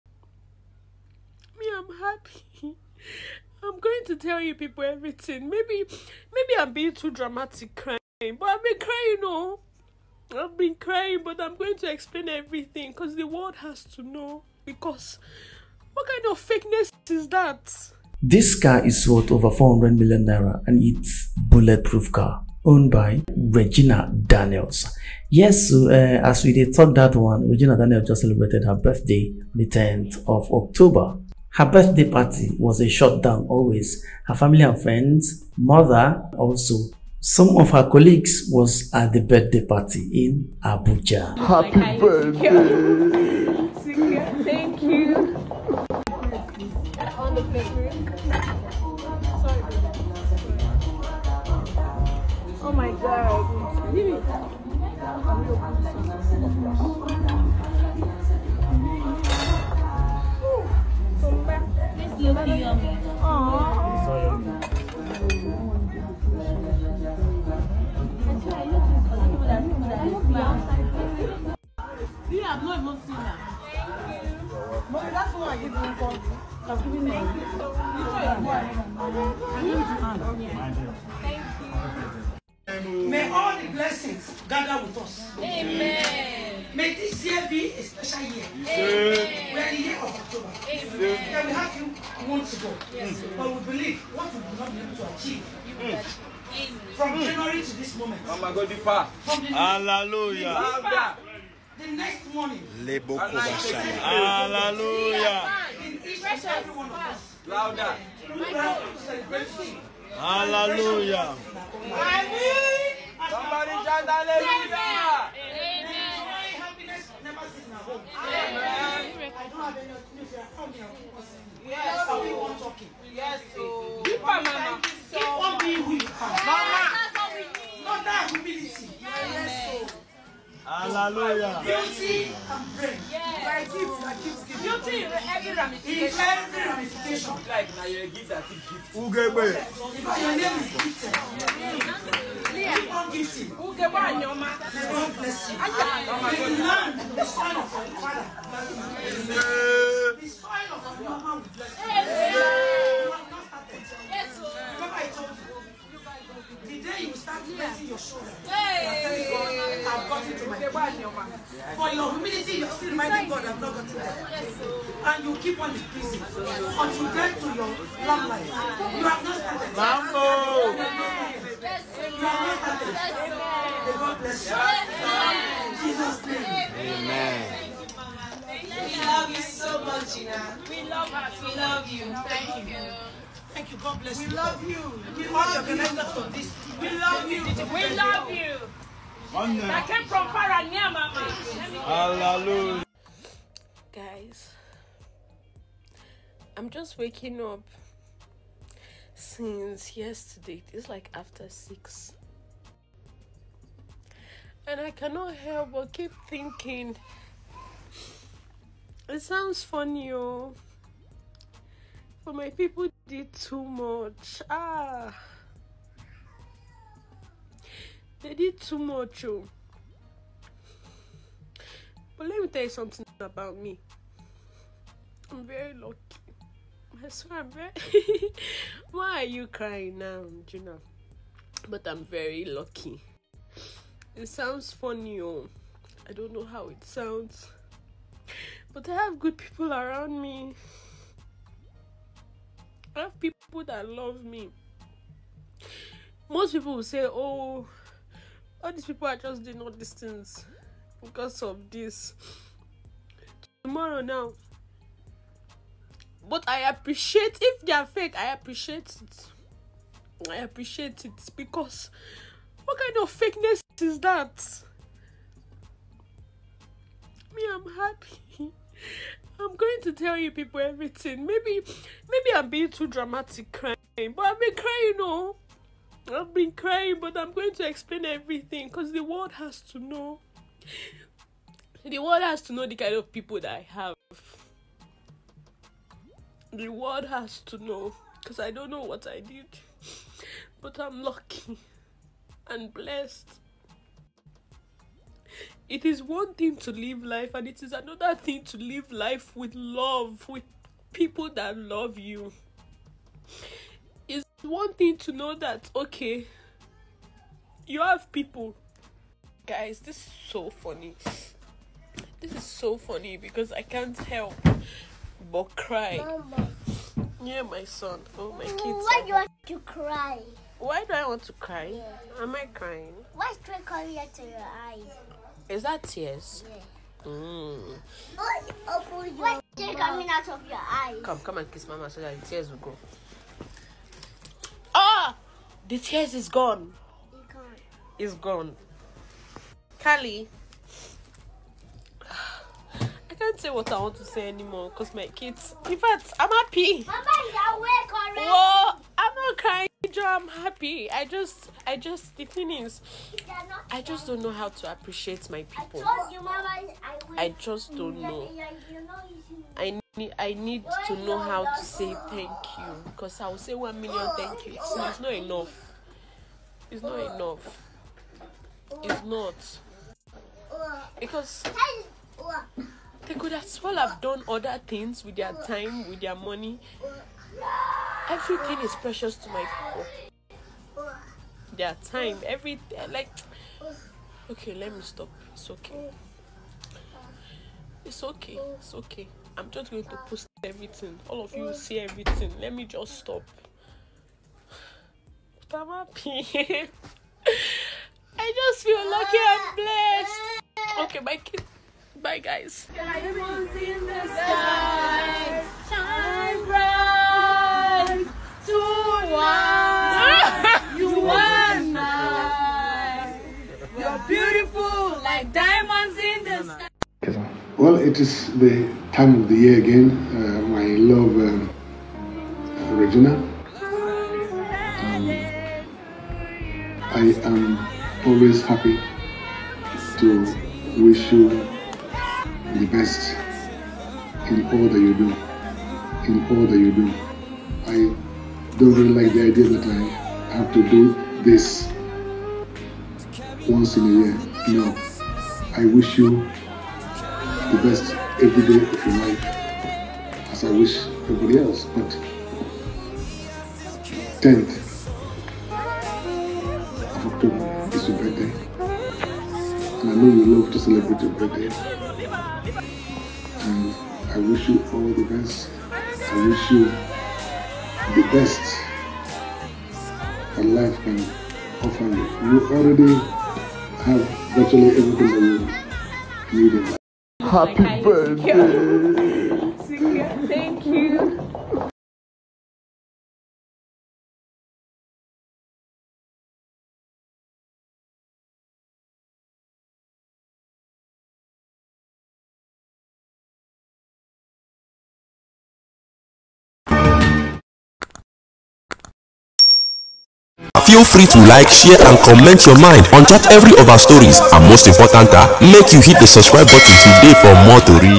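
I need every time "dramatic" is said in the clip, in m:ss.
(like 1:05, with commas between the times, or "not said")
0:07, 4:32.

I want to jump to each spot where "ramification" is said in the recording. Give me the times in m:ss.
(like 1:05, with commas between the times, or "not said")
2:15.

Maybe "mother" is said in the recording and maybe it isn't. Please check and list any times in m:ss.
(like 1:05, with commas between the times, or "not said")
0:35.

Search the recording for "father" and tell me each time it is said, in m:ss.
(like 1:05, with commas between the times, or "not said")
2:28.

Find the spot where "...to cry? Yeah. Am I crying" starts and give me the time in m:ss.
5:21.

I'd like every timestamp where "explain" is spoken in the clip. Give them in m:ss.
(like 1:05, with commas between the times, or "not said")
0:11, 4:37.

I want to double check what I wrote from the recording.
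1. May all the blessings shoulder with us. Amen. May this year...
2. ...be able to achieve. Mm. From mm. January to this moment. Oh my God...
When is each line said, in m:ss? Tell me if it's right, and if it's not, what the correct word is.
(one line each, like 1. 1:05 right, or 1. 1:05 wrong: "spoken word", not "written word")
1. 1:23 wrong: "gather", not "shoulder"
2. 1:34 right.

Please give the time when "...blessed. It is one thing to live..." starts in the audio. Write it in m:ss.
4:52.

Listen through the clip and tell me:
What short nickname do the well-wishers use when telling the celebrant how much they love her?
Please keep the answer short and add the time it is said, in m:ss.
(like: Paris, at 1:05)
Gina, at 3:00.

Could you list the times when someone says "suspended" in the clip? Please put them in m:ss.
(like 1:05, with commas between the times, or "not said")
not said.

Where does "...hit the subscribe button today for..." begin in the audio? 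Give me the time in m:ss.
8:25.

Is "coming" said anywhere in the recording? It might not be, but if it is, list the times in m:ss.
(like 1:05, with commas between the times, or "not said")
5:23, 5:29.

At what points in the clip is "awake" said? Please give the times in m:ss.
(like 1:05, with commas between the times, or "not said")
5:47.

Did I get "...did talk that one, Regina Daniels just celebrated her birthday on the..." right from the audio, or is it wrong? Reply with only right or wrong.
right.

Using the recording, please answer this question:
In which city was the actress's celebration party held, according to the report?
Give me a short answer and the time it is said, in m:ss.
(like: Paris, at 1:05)
Abuja, at 0:40.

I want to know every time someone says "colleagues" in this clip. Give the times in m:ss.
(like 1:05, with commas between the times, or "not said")
0:37.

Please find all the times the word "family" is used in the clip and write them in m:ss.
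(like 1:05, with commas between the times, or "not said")
0:34.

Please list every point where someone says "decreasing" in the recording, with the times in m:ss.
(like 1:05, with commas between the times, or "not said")
2:45.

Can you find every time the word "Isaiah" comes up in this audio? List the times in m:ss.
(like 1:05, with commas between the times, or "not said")
not said.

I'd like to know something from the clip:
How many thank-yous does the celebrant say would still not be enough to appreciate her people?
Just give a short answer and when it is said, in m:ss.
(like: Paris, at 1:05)
one million, at 6:03.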